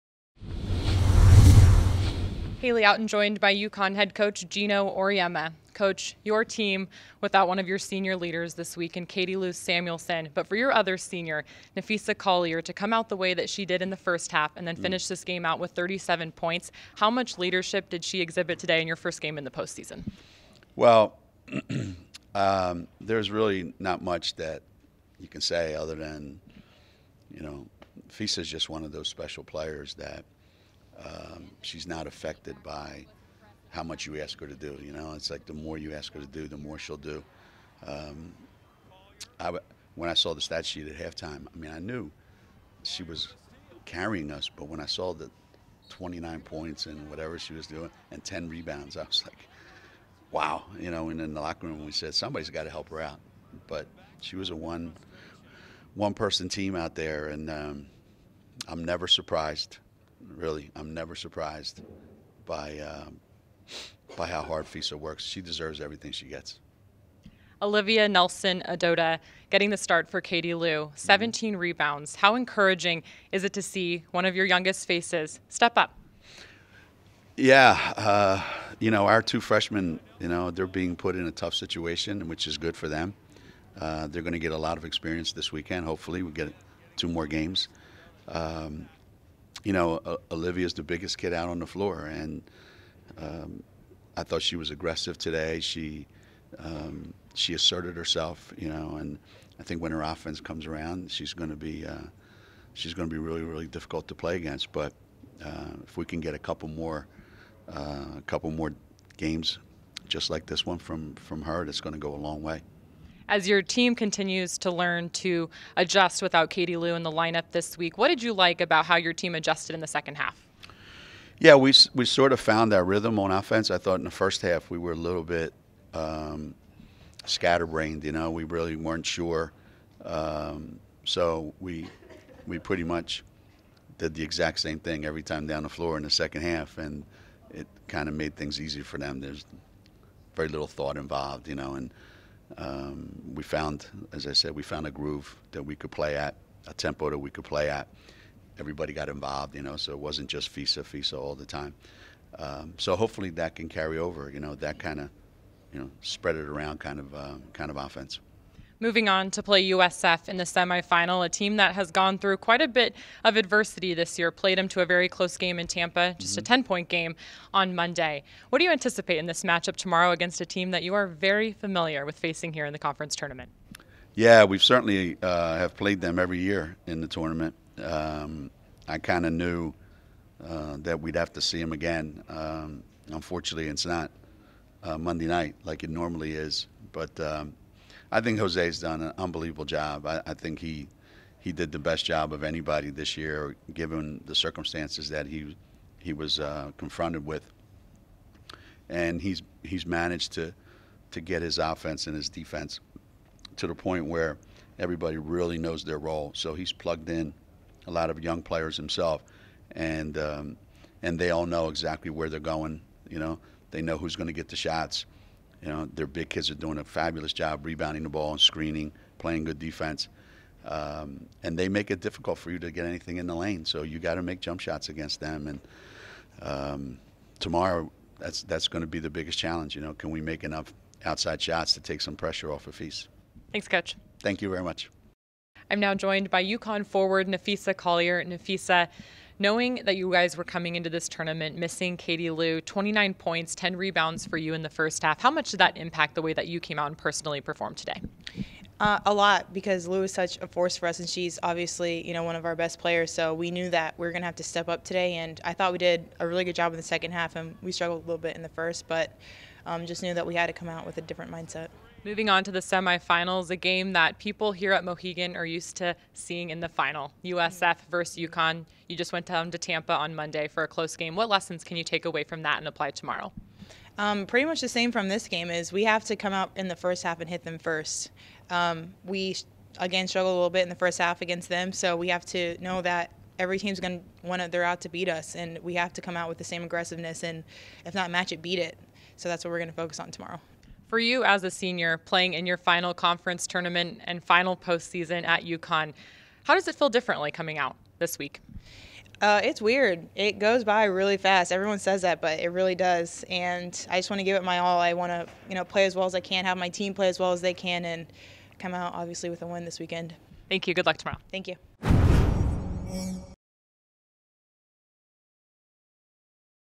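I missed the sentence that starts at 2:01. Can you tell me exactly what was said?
Yeah, we, we sort of found our rhythm on offense.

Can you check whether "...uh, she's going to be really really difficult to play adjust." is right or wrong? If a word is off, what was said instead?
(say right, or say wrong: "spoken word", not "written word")
wrong: "against", not "adjust".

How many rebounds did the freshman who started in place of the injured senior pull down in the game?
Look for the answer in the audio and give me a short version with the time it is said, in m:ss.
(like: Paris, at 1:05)
17, at 1:10.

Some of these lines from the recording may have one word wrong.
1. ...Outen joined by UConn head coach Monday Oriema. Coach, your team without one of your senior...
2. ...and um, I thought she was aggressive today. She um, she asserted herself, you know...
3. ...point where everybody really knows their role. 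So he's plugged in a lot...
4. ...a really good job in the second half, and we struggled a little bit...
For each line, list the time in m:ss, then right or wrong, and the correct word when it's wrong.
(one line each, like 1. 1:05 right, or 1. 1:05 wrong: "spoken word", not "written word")
1. 0:02 wrong: "Gino", not "Monday"
2. 1:32 right
3. 3:23 right
4. 4:16 right.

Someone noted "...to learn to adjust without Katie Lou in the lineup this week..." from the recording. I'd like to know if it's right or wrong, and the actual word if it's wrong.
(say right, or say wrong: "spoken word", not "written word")
right.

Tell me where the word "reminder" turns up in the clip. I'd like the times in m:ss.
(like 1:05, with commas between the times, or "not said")
not said.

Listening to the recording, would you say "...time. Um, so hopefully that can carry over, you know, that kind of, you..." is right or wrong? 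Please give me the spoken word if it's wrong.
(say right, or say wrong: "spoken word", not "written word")
right.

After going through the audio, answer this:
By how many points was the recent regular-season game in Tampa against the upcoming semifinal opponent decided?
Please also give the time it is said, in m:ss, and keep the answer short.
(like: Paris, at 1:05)
10, at 2:46.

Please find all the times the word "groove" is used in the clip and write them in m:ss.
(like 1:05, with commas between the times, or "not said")
2:24.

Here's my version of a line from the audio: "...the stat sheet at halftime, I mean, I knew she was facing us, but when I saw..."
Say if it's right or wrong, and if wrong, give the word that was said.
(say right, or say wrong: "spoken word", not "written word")
wrong: "carrying", not "facing".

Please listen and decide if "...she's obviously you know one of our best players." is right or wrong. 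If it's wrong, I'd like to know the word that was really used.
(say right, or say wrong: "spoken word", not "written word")
right.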